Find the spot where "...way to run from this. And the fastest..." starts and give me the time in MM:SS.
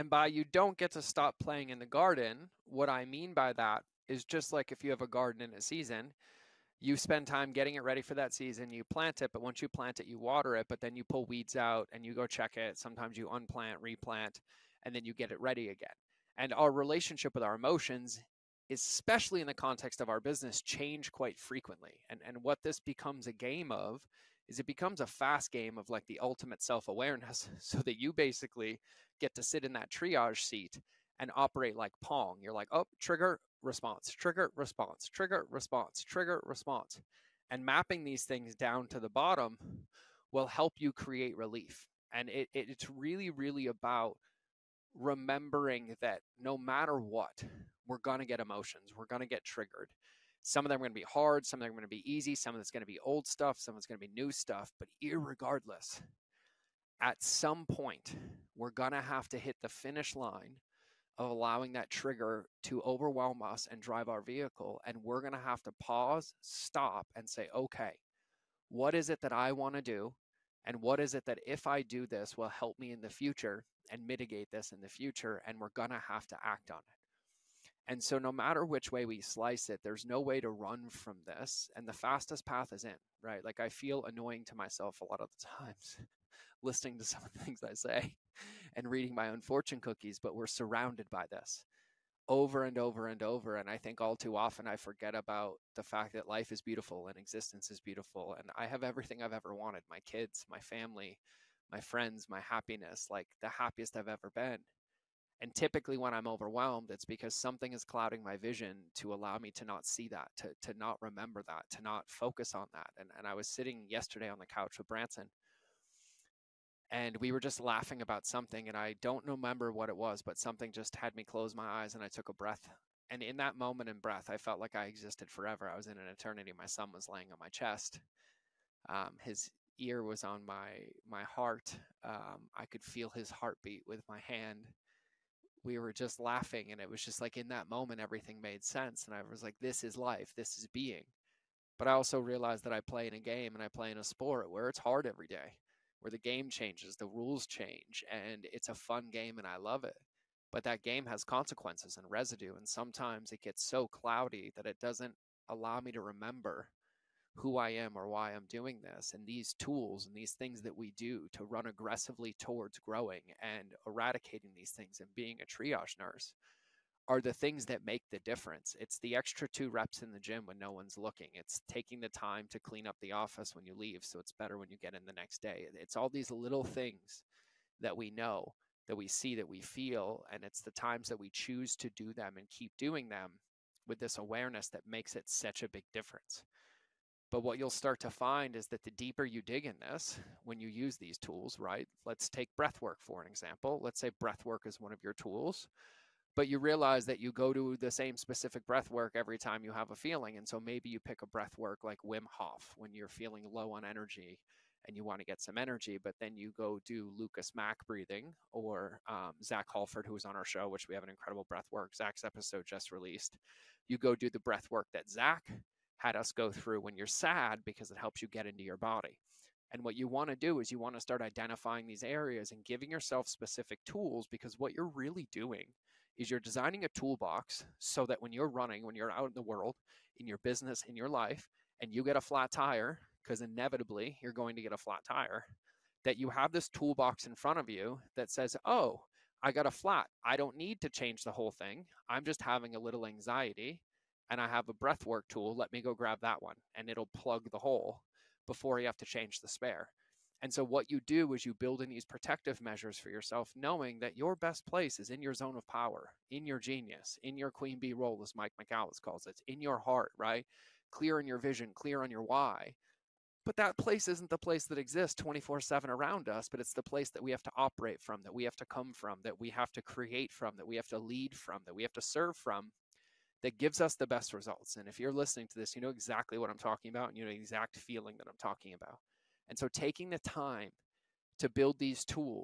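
01:20.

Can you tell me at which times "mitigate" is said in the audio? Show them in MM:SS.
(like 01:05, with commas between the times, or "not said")
01:14.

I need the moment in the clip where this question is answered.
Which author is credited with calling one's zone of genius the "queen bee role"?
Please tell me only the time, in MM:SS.
04:18.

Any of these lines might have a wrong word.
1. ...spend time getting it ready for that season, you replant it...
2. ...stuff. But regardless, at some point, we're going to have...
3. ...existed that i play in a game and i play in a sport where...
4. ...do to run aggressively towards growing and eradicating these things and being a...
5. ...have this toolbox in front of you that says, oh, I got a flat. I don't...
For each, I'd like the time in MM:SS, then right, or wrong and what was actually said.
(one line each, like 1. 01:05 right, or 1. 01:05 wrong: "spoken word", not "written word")
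1. 00:06 wrong: "plant", not "replant"
2. 00:54 right
3. 02:22 wrong: "realized", not "existed"
4. 02:40 right
5. 03:56 right.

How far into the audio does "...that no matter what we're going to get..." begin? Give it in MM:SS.
00:46.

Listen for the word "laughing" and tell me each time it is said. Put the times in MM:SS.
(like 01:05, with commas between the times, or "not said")
01:57, 02:16.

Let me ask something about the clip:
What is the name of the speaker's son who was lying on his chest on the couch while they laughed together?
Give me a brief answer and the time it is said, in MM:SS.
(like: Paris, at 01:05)
Branson, at 01:54.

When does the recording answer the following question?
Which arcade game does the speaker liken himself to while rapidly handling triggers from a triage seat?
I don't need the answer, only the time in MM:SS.
00:32.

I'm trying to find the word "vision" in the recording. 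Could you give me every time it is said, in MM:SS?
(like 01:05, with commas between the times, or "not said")
01:48, 04:21.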